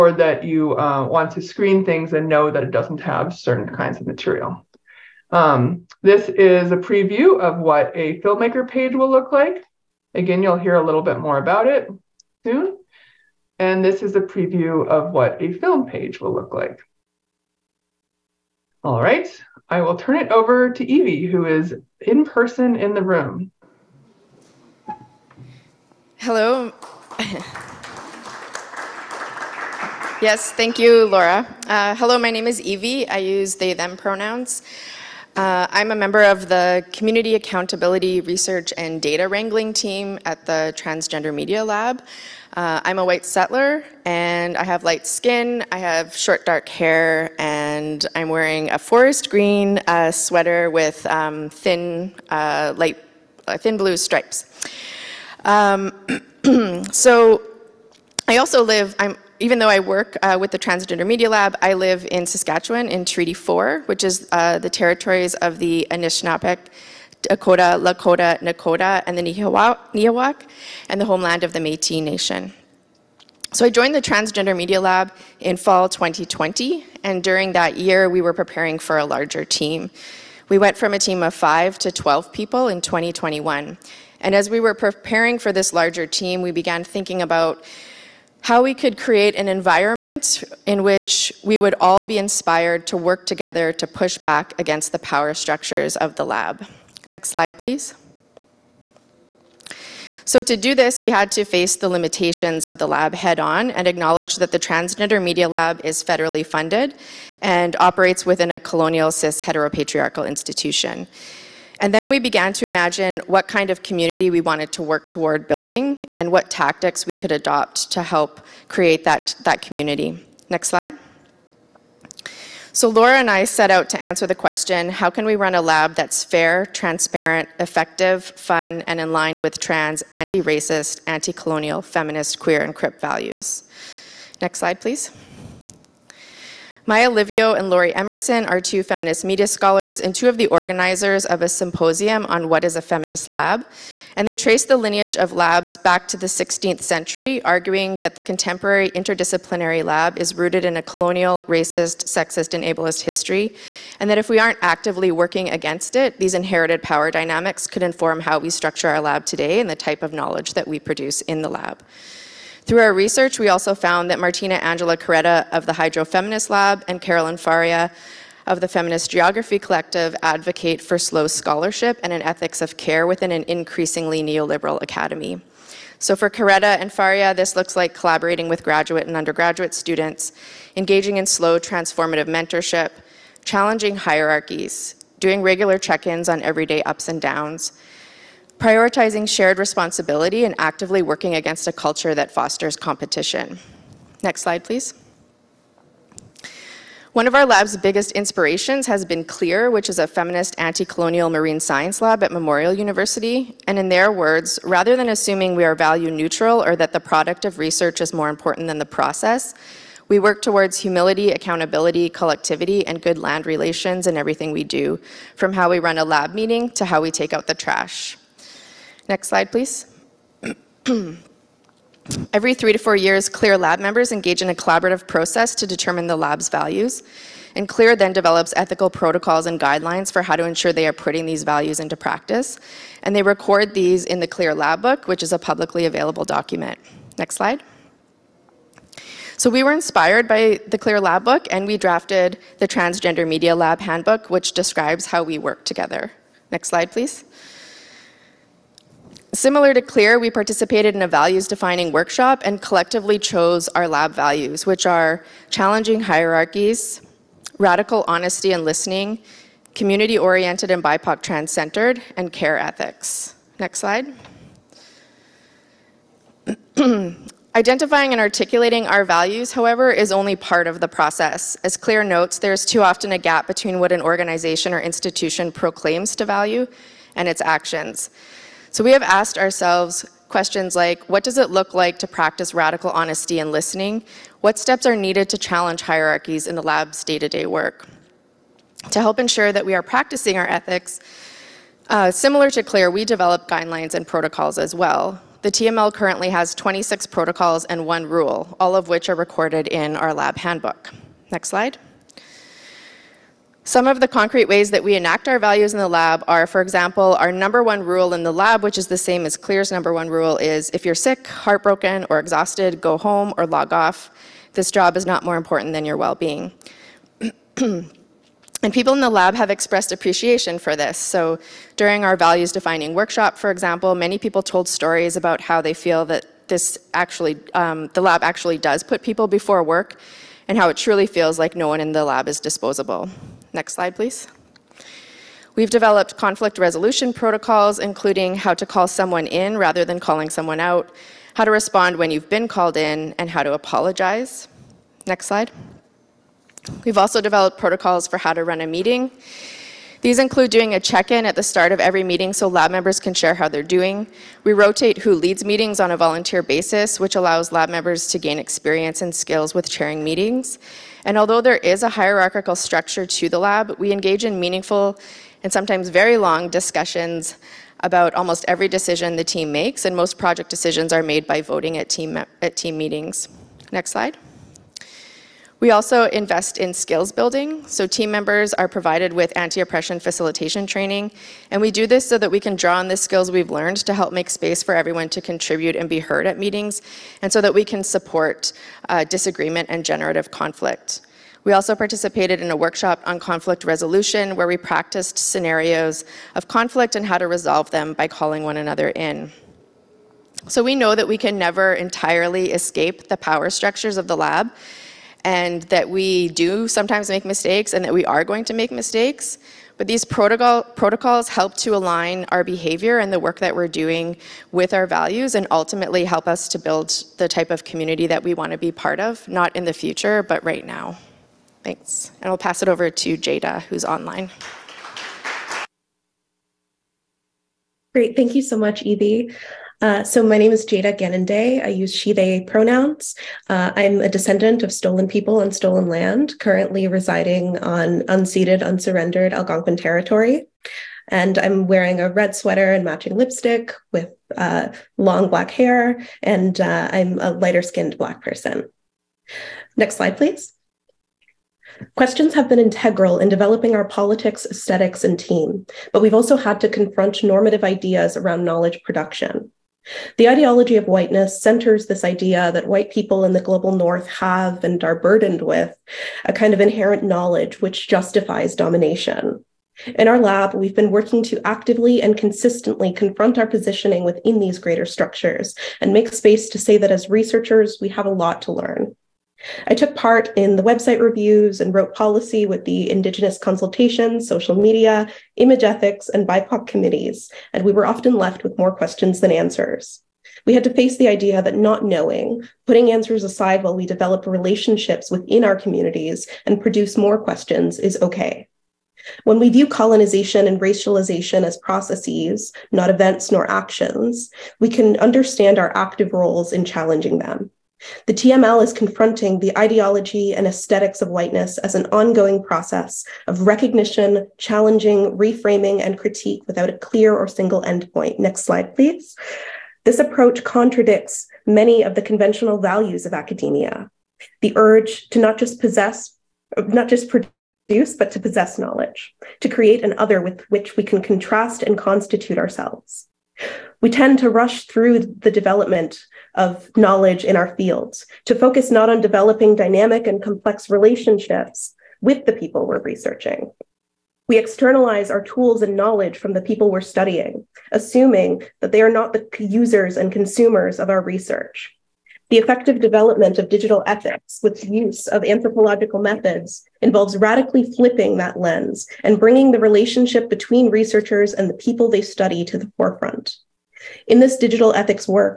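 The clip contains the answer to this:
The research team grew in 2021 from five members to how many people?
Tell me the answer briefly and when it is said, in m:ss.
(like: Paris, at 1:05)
12, at 1:21.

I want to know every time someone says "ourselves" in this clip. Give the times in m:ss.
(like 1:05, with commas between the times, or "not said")
4:39, 8:52.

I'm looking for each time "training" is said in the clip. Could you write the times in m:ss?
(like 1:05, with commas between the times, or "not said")
6:20.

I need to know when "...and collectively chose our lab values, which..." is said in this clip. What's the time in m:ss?
4:12.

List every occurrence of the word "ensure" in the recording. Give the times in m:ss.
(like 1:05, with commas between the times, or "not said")
3:50, 4:49.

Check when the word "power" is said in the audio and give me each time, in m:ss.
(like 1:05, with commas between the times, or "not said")
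1:34, 2:36, 6:43.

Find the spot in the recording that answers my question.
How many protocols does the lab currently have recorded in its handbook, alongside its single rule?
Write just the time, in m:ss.
4:56.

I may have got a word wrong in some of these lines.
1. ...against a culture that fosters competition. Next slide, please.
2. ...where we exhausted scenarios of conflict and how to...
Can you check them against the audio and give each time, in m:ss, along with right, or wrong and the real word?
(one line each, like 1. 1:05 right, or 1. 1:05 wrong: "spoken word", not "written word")
1. 3:11 right
2. 6:34 wrong: "practiced", not "exhausted".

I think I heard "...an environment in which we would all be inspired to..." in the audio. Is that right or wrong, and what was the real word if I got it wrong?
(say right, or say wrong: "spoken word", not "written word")
right.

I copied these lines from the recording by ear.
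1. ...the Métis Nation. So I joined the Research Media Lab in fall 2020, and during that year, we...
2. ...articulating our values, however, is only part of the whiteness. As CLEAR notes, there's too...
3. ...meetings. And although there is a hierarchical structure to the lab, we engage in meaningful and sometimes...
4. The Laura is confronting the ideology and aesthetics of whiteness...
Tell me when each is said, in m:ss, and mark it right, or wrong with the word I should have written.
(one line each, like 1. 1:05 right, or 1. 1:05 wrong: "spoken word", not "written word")
1. 1:11 wrong: "Transgender", not "Research"
2. 4:28 wrong: "process", not "whiteness"
3. 6:00 right
4. 8:28 wrong: "TML", not "Laura".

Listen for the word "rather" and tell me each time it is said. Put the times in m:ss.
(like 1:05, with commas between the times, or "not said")
3:24, 5:39.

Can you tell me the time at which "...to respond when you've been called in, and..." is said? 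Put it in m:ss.
5:41.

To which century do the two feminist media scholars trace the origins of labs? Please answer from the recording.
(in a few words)
16th century.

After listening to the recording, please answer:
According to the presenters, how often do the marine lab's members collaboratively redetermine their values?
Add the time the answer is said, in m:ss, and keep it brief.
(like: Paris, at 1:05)
every 3 to 4 years, at 3:42.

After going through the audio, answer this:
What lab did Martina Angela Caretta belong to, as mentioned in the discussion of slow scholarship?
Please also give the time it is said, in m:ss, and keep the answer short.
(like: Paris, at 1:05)
Hydro Feminist Lab, at 2:45.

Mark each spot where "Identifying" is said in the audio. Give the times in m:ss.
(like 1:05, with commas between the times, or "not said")
4:27.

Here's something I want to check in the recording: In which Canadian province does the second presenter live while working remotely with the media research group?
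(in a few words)
Saskatchewan.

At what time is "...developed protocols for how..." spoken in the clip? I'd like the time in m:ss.
5:47.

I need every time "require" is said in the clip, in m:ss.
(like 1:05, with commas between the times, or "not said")
not said.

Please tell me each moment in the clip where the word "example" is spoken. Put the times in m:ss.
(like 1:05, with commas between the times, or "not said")
5:06, 5:23.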